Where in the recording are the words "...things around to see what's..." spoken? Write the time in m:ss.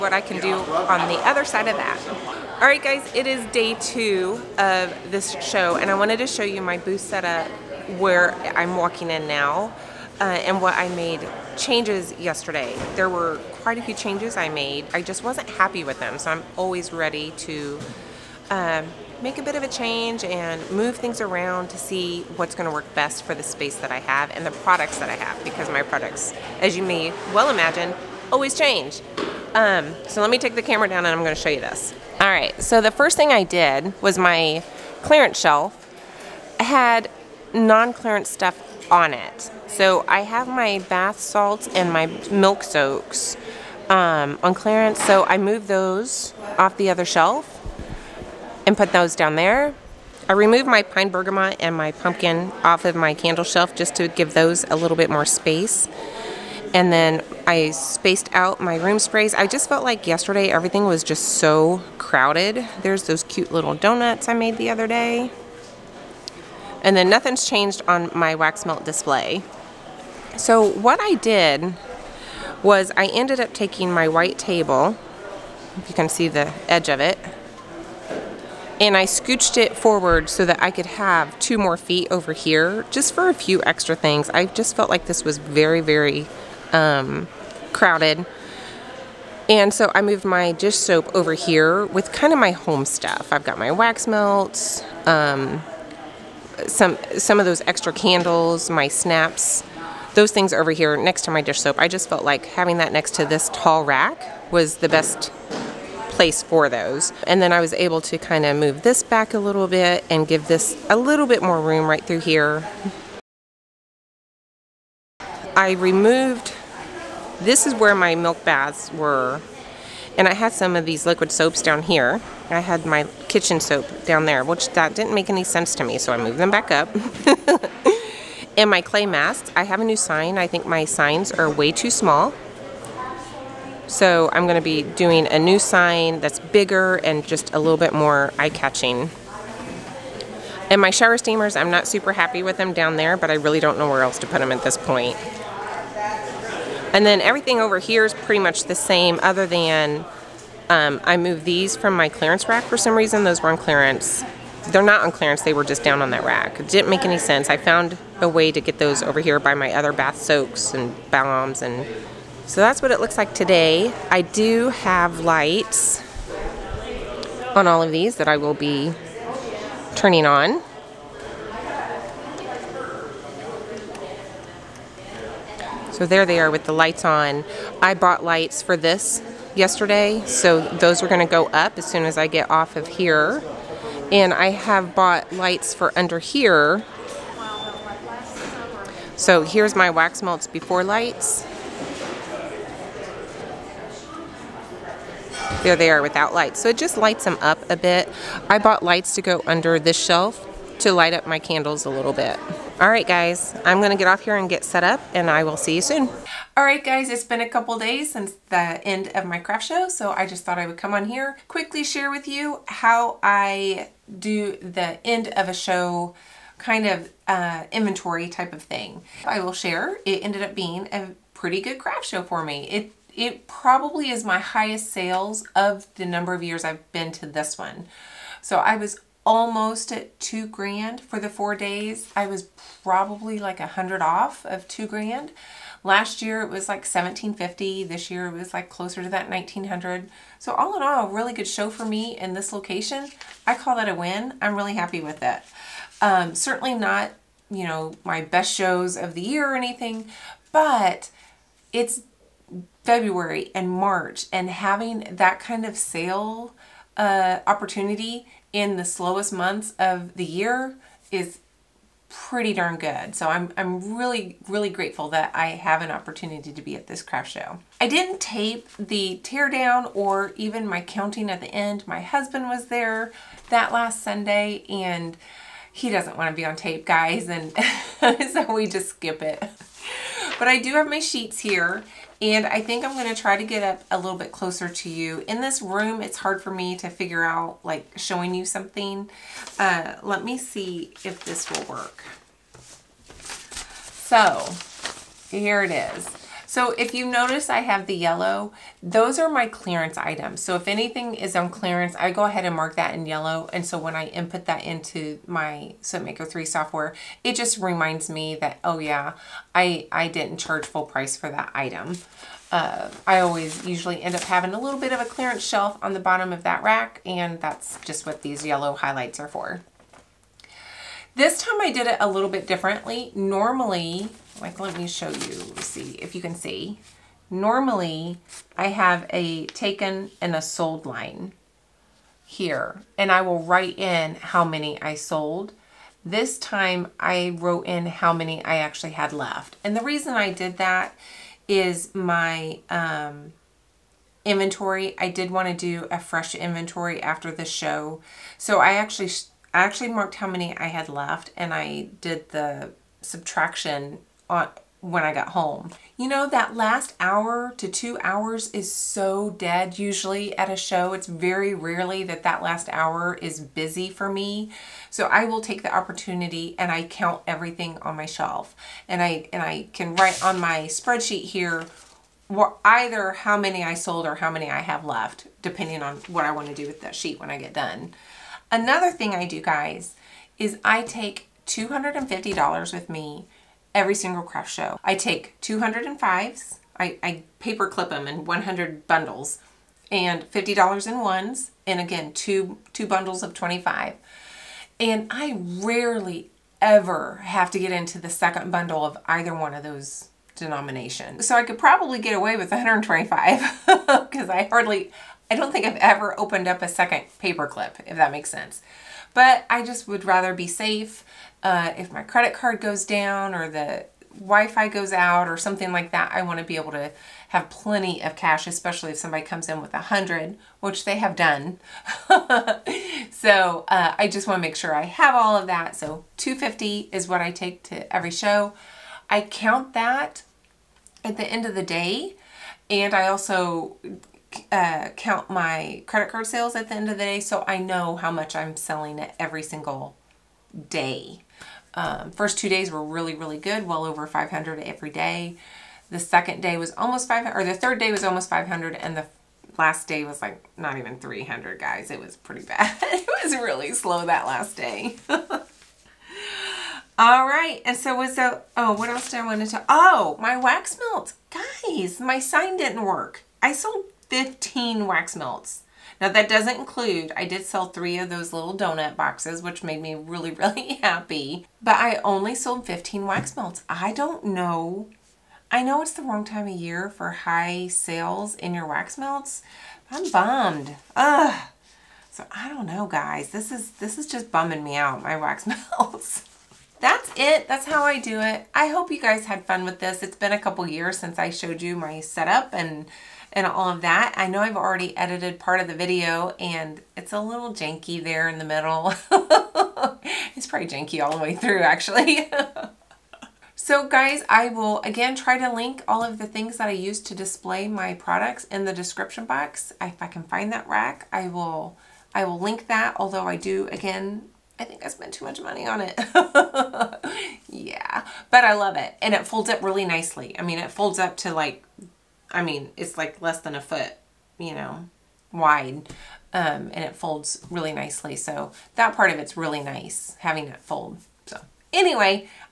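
0:20.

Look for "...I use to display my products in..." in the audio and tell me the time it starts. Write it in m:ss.
8:26.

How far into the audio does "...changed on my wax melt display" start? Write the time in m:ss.
1:07.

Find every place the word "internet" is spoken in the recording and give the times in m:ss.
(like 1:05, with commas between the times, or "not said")
not said.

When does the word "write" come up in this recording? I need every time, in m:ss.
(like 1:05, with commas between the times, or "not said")
5:33, 6:09.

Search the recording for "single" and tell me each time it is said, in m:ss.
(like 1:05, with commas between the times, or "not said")
6:23, 7:19.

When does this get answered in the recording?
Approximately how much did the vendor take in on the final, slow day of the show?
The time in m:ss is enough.
7:30.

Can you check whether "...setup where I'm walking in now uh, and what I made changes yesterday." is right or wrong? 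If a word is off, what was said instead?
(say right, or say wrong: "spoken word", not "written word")
right.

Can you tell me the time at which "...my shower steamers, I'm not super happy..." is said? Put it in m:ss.
2:20.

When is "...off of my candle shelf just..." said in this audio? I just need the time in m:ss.
0:52.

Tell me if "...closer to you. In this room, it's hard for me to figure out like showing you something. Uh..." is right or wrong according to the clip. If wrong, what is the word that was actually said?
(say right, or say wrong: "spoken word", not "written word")
right.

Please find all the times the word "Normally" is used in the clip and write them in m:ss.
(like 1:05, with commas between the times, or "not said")
5:23, 5:27.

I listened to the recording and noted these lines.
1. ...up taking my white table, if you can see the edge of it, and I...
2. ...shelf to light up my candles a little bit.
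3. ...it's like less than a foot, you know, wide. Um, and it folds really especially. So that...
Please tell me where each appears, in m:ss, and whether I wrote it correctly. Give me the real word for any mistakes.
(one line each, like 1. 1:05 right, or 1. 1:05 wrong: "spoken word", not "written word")
1. 1:13 right
2. 3:20 right
3. 8:42 wrong: "nicely", not "especially".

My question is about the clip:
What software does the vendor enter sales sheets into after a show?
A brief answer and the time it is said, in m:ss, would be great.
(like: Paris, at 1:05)
SoapMaker 3, at 5:05.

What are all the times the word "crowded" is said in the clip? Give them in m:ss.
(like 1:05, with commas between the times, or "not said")
1:01, 1:27.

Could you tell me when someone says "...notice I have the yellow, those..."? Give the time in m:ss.
4:57.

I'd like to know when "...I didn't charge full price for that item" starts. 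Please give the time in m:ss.
5:09.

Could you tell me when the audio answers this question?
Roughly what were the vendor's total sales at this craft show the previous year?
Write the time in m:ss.
3:56.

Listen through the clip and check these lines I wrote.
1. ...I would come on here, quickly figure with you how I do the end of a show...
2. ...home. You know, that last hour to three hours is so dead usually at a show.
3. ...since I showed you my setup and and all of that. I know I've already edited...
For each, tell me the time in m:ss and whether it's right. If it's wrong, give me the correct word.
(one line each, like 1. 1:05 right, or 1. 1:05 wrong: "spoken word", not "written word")
1. 3:30 wrong: "share", not "figure"
2. 5:55 wrong: "two", not "three"
3. 8:10 right.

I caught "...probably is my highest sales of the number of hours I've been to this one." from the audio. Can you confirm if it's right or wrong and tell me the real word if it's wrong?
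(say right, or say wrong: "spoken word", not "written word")
wrong: "years", not "hours".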